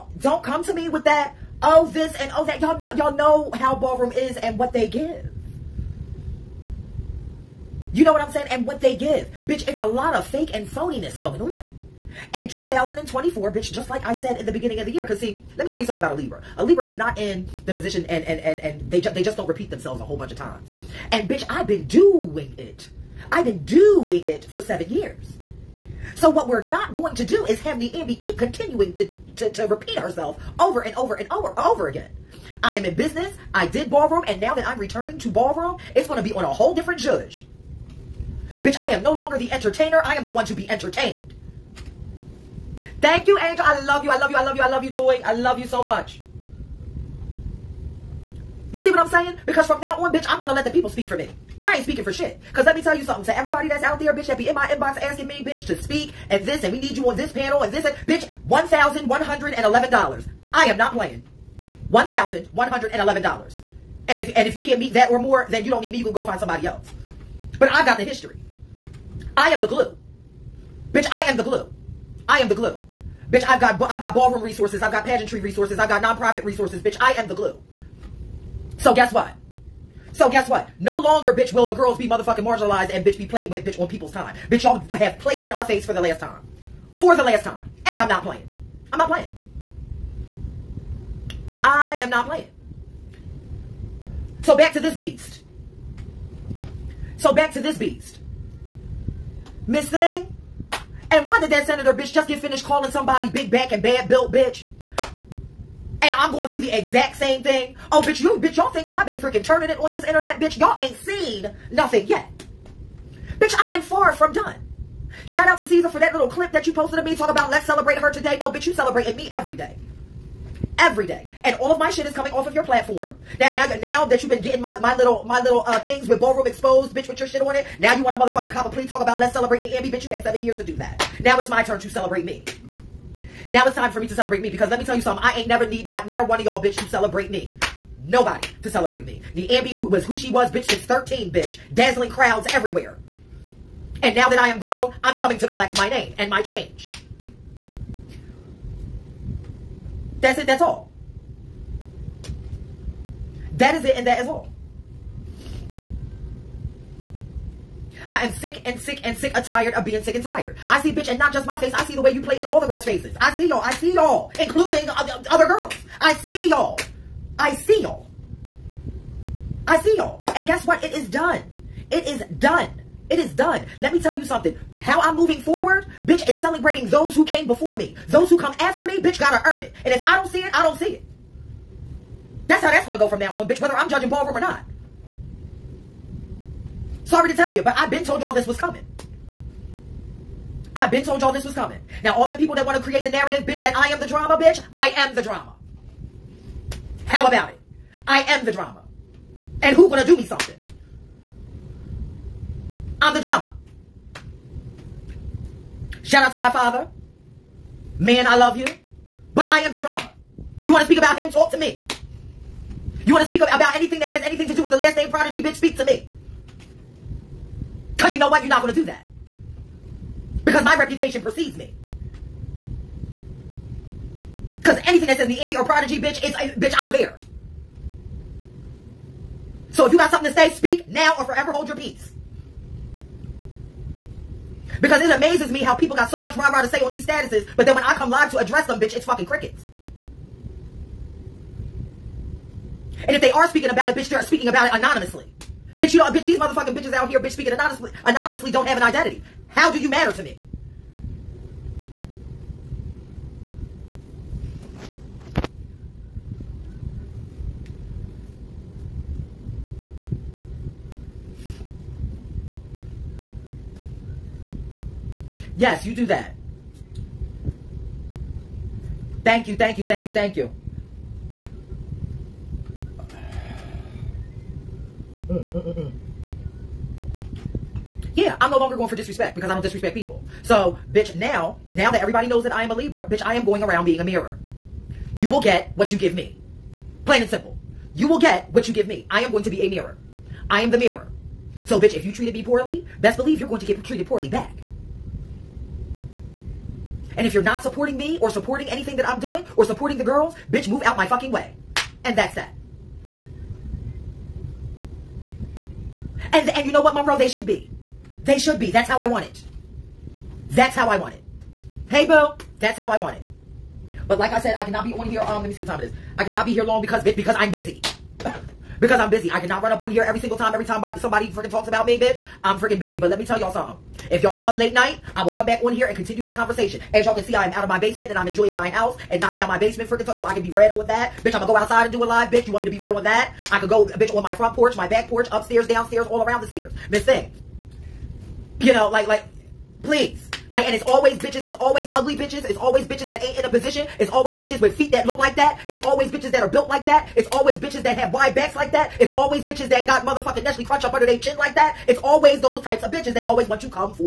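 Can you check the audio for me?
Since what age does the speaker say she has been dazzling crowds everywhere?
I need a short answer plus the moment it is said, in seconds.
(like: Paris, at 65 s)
13, at 140 s.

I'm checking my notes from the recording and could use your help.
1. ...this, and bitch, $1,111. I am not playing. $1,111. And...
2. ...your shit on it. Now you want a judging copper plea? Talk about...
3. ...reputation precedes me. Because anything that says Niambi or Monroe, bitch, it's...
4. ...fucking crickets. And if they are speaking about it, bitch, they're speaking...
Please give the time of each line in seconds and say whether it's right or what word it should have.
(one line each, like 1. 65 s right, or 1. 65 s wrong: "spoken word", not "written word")
1. 57 s right
2. 127 s wrong: "motherfucking", not "judging"
3. 220 s wrong: "Prodigy", not "Monroe"
4. 239 s right.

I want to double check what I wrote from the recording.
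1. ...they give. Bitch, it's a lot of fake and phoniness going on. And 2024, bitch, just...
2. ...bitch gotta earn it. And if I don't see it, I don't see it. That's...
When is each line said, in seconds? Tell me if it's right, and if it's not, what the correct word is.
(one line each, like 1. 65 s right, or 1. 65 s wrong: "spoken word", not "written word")
1. 8 s right
2. 179 s right.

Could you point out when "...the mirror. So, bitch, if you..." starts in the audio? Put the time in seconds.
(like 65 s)
290 s.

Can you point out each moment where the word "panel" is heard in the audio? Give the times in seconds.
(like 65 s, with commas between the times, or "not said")
57 s.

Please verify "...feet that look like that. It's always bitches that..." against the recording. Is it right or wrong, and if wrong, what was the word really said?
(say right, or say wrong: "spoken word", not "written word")
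right.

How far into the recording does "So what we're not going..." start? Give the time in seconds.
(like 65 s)
26 s.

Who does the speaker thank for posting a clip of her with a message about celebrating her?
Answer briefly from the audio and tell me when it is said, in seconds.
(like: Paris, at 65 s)
Caesar, at 115 s.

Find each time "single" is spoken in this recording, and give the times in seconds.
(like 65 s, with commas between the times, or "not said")
320 s.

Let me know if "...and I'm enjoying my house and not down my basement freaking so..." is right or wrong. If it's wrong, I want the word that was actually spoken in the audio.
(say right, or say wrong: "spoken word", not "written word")
right.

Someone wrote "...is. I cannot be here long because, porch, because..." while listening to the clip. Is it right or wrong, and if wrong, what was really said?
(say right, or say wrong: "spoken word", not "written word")
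wrong: "bitch", not "porch".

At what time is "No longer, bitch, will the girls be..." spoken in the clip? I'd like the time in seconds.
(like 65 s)
80 s.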